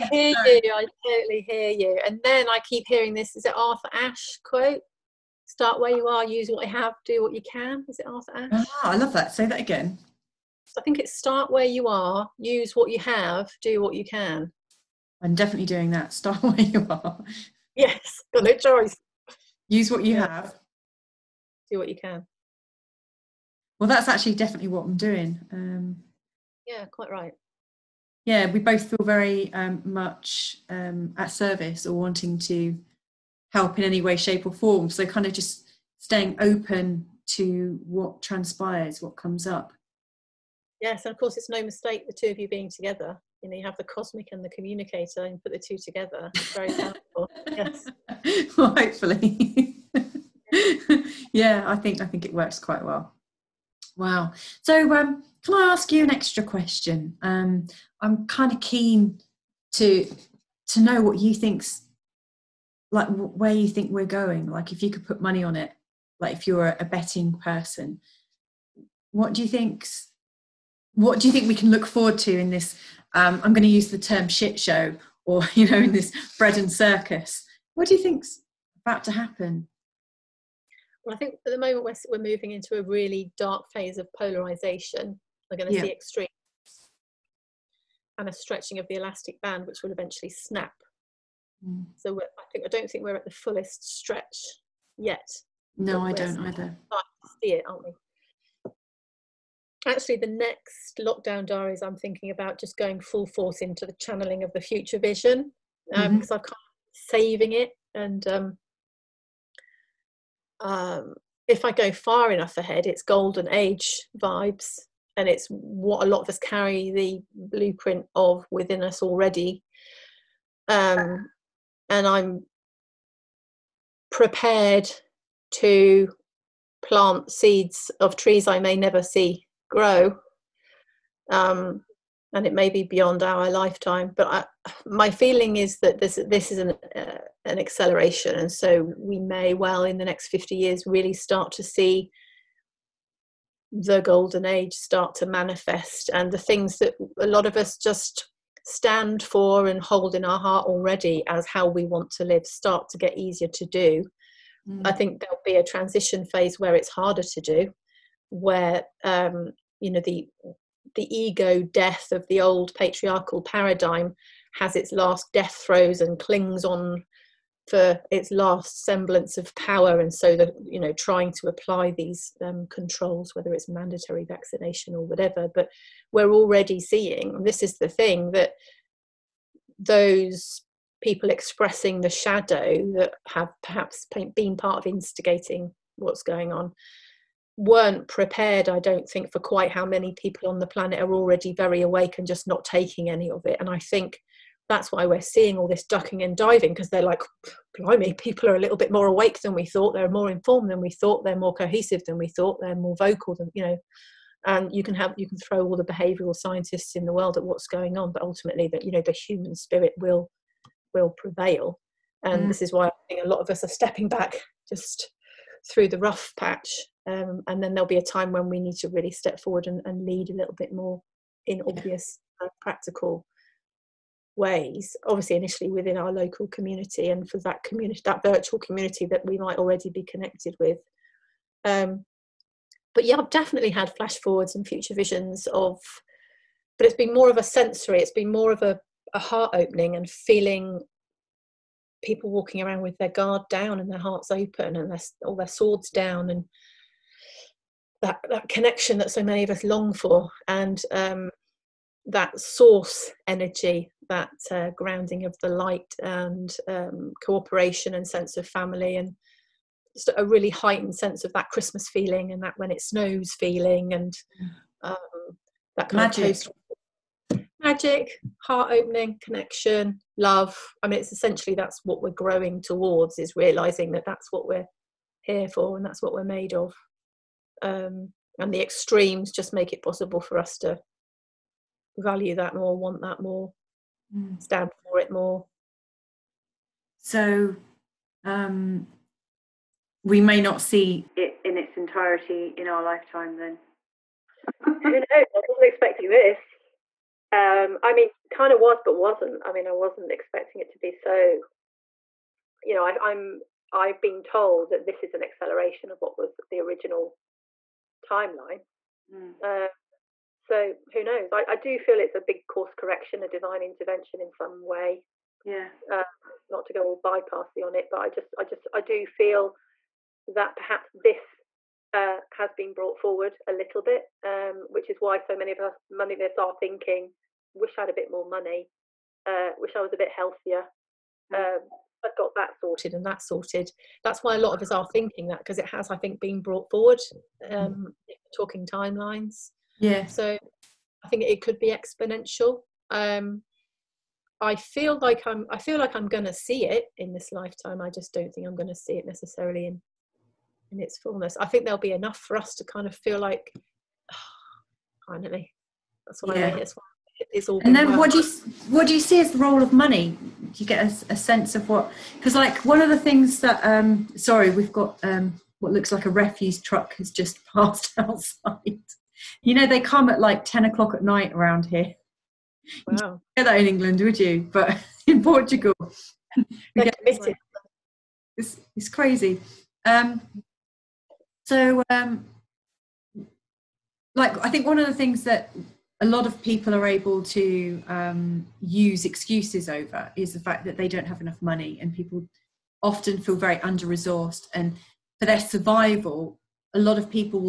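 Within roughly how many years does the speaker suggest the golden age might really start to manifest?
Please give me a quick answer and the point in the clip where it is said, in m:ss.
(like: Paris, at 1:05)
50, at 2:20.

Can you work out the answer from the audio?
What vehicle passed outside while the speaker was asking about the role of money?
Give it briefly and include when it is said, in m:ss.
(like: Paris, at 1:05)
refuse truck, at 6:06.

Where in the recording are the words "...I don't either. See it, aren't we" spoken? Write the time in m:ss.
1:36.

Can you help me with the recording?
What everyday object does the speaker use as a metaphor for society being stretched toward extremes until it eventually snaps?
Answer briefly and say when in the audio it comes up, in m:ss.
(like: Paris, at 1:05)
elastic band, at 1:28.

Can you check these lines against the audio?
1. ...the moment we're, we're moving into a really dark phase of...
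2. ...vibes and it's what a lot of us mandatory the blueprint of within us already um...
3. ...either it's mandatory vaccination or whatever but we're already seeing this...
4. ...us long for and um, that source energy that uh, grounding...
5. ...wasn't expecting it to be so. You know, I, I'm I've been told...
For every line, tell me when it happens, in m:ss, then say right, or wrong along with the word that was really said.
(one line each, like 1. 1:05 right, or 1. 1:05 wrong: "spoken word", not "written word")
1. 1:21 right
2. 1:54 wrong: "carry", not "mandatory"
3. 2:53 wrong: "whether", not "either"
4. 4:09 right
5. 4:59 right.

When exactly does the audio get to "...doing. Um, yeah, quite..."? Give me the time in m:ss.
0:24.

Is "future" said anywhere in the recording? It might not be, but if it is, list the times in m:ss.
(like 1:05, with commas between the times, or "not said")
1:44, 3:54.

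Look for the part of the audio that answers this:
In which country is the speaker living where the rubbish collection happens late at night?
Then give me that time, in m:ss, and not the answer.
6:15.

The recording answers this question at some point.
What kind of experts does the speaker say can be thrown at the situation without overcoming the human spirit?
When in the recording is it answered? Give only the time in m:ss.
3:25.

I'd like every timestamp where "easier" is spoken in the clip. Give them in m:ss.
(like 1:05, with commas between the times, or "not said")
2:33.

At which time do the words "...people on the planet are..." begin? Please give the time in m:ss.
3:10.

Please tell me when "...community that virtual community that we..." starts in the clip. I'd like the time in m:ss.
3:47.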